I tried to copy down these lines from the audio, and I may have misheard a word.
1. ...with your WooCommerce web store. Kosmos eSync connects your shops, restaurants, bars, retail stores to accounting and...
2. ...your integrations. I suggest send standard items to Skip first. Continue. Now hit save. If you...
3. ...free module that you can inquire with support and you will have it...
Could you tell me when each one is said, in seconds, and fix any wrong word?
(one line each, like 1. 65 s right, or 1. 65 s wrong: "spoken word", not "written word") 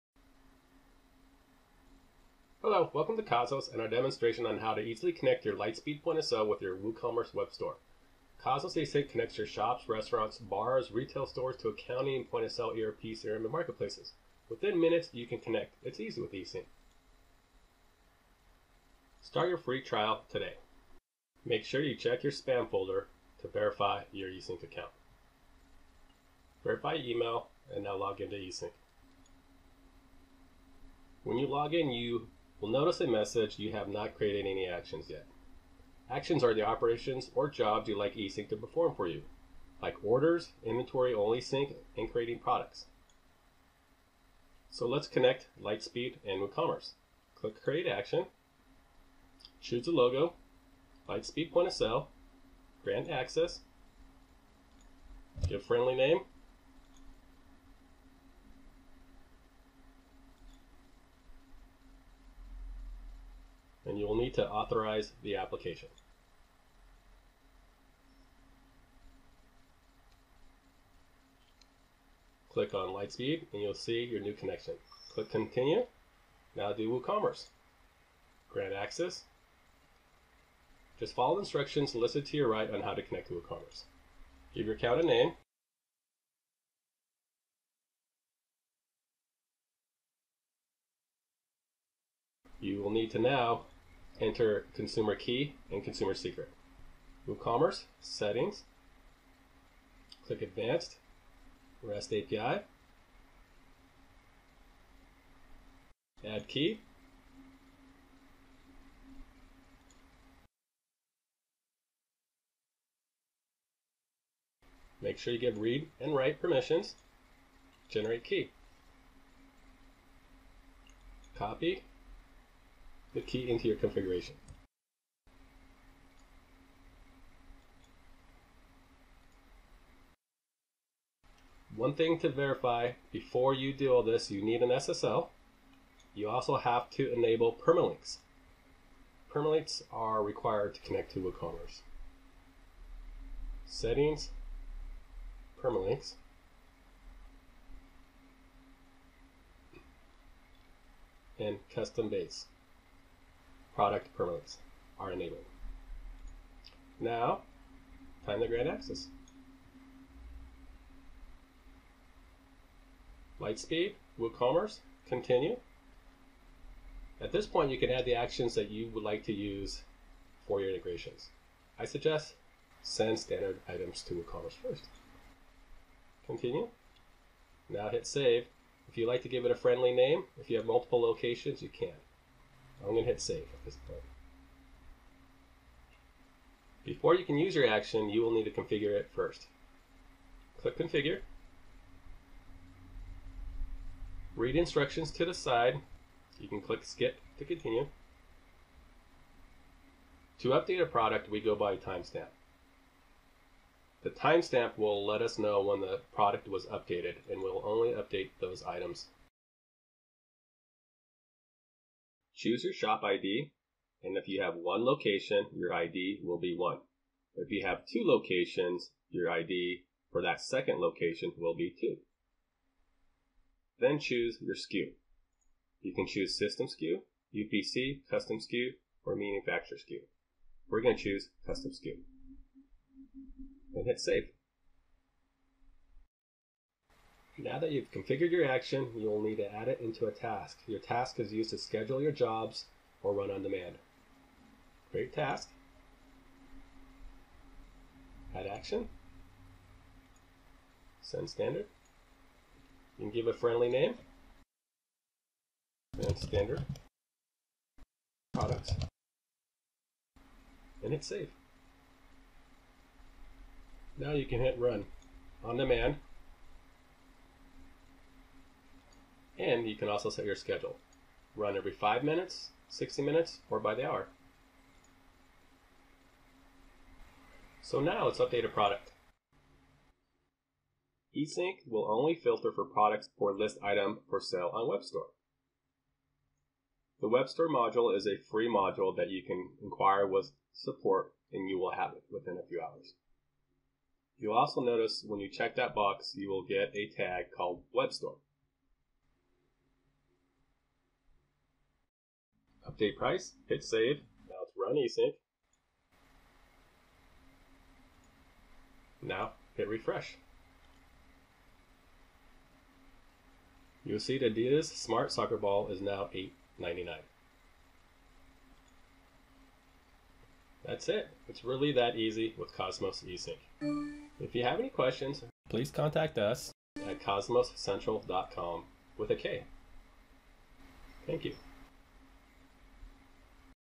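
1. 6 s right
2. 170 s wrong: "WooCommerce", not "Skip"
3. 288 s right.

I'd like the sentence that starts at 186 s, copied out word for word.
Before you can use your action, you will need to configure it first.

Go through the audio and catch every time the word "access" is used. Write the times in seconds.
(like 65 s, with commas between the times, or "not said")
53 s, 78 s, 158 s.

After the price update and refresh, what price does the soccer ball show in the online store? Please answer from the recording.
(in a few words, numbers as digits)
$8.99.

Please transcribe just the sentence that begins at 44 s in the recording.
So let's connect Lightspeed and WooCommerce.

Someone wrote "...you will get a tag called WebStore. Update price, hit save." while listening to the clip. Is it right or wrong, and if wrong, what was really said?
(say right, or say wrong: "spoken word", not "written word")
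right.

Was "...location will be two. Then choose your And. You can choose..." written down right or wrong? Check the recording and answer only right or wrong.
wrong.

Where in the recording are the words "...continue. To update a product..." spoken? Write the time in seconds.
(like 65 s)
197 s.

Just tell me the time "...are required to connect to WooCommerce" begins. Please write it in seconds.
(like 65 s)
139 s.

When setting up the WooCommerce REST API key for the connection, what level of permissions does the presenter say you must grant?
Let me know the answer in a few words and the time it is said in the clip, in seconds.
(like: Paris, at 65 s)
Read and write, at 115 s.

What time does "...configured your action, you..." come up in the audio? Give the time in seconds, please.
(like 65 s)
237 s.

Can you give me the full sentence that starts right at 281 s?
eSync will only filter for products or list item for sale on WebStore.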